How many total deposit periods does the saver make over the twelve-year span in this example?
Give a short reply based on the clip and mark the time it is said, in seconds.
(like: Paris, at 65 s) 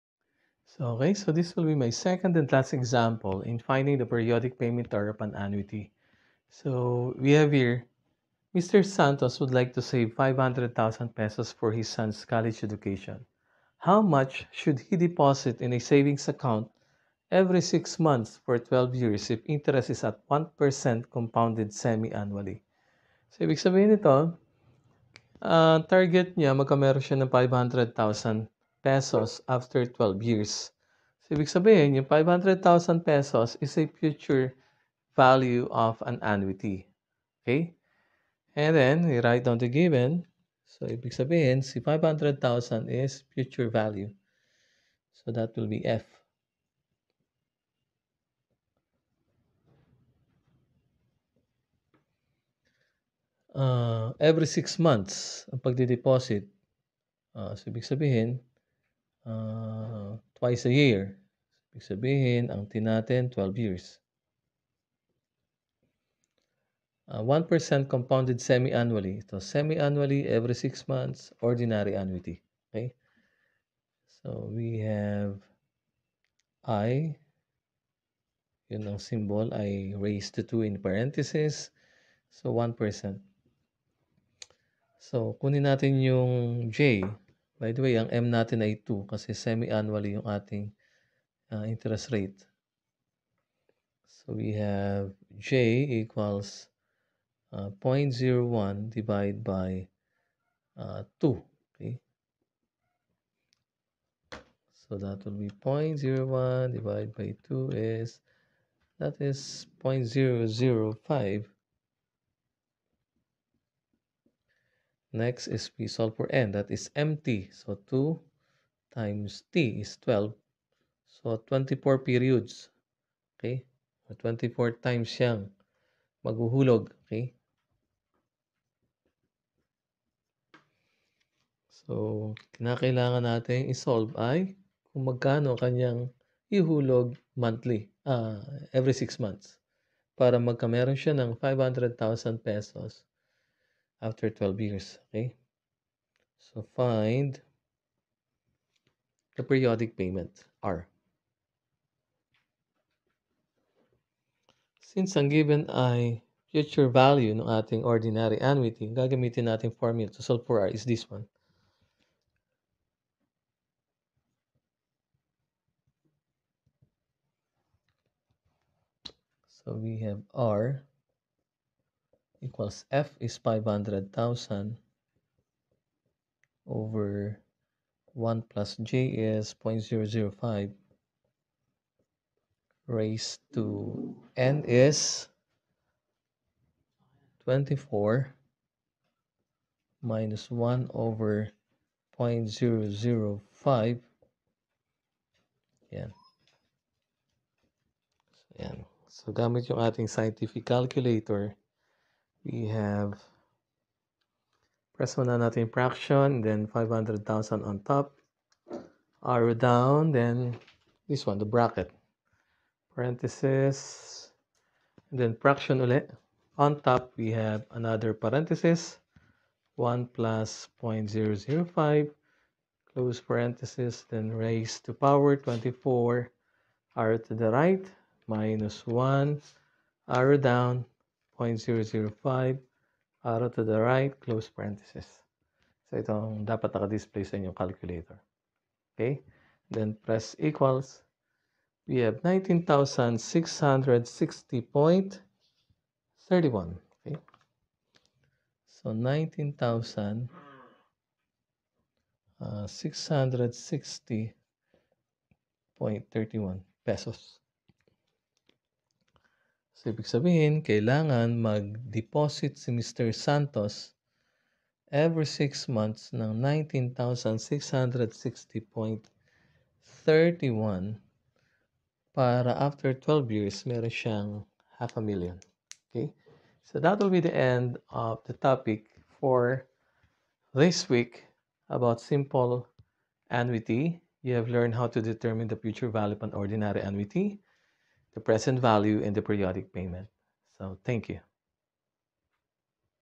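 24, at 121 s.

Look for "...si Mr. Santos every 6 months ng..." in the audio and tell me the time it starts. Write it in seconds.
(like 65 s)
262 s.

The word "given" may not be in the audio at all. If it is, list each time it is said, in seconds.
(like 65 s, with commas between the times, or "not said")
39 s, 155 s.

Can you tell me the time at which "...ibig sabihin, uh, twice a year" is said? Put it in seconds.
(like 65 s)
57 s.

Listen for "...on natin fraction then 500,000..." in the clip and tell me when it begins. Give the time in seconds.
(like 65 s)
205 s.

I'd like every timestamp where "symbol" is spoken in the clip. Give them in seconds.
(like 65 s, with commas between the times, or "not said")
78 s.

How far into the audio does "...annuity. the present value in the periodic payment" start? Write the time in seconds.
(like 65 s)
286 s.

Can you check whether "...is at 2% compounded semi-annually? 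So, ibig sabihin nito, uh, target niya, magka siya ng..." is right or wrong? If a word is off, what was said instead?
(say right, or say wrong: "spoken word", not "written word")
wrong: "1", not "2".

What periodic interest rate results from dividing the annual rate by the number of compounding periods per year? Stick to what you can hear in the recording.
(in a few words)
0.005.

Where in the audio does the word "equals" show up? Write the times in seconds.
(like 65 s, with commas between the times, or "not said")
96 s, 172 s, 240 s.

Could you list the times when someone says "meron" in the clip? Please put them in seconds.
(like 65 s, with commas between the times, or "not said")
140 s, 273 s.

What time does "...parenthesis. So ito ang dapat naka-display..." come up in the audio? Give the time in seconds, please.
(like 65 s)
234 s.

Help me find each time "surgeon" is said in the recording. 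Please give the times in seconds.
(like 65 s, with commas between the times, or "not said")
not said.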